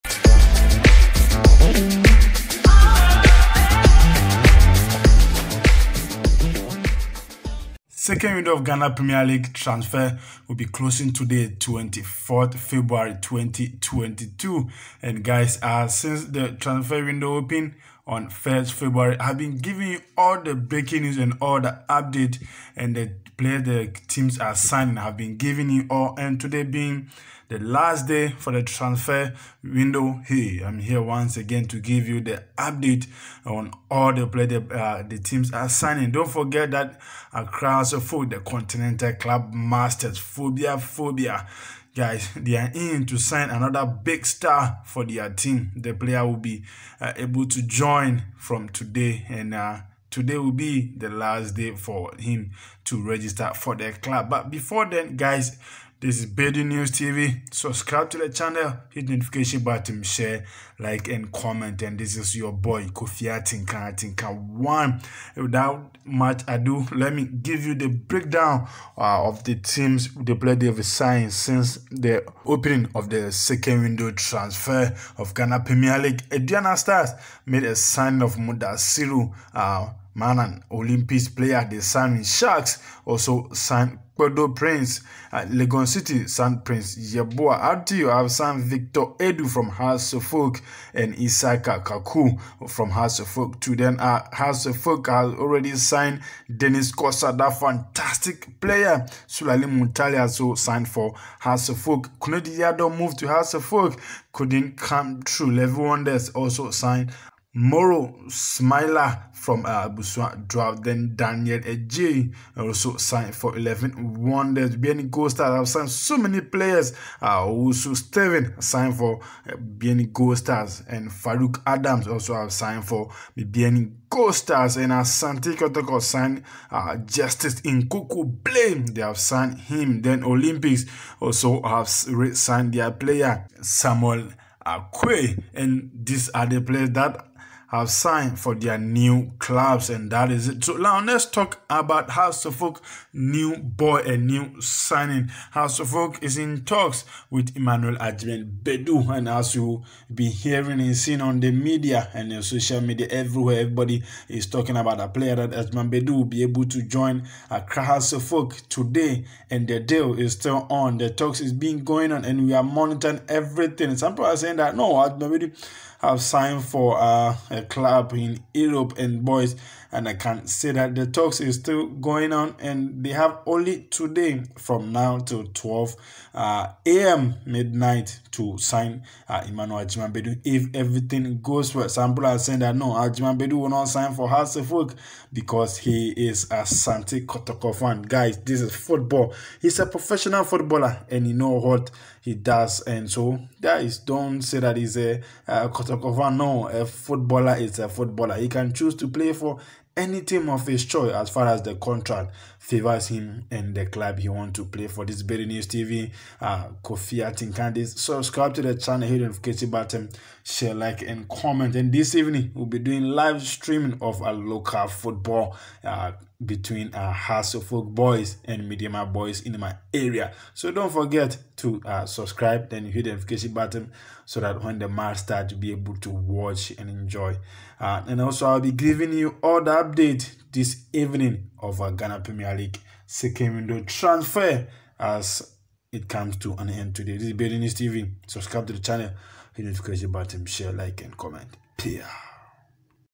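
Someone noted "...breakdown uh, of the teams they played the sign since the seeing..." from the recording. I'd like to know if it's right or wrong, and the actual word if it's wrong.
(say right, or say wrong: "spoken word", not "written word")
wrong: "opening", not "seeing".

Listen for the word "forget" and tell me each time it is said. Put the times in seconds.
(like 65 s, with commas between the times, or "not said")
36 s, 220 s.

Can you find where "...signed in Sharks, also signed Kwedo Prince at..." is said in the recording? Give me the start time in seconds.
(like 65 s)
81 s.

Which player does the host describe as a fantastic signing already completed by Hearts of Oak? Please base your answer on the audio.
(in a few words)
Dennis Korsah.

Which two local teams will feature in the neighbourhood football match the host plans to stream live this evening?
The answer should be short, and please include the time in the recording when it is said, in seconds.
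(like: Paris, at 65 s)
Folk boys and Mediama boys, at 217 s.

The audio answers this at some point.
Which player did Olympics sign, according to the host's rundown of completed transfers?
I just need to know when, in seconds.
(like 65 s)
133 s.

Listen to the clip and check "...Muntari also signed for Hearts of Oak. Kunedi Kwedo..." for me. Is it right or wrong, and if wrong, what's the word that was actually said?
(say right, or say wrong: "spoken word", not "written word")
wrong: "Yado", not "Kwedo".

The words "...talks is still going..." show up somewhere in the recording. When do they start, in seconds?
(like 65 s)
171 s.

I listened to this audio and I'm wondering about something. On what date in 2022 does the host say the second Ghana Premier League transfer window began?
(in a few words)
1st February.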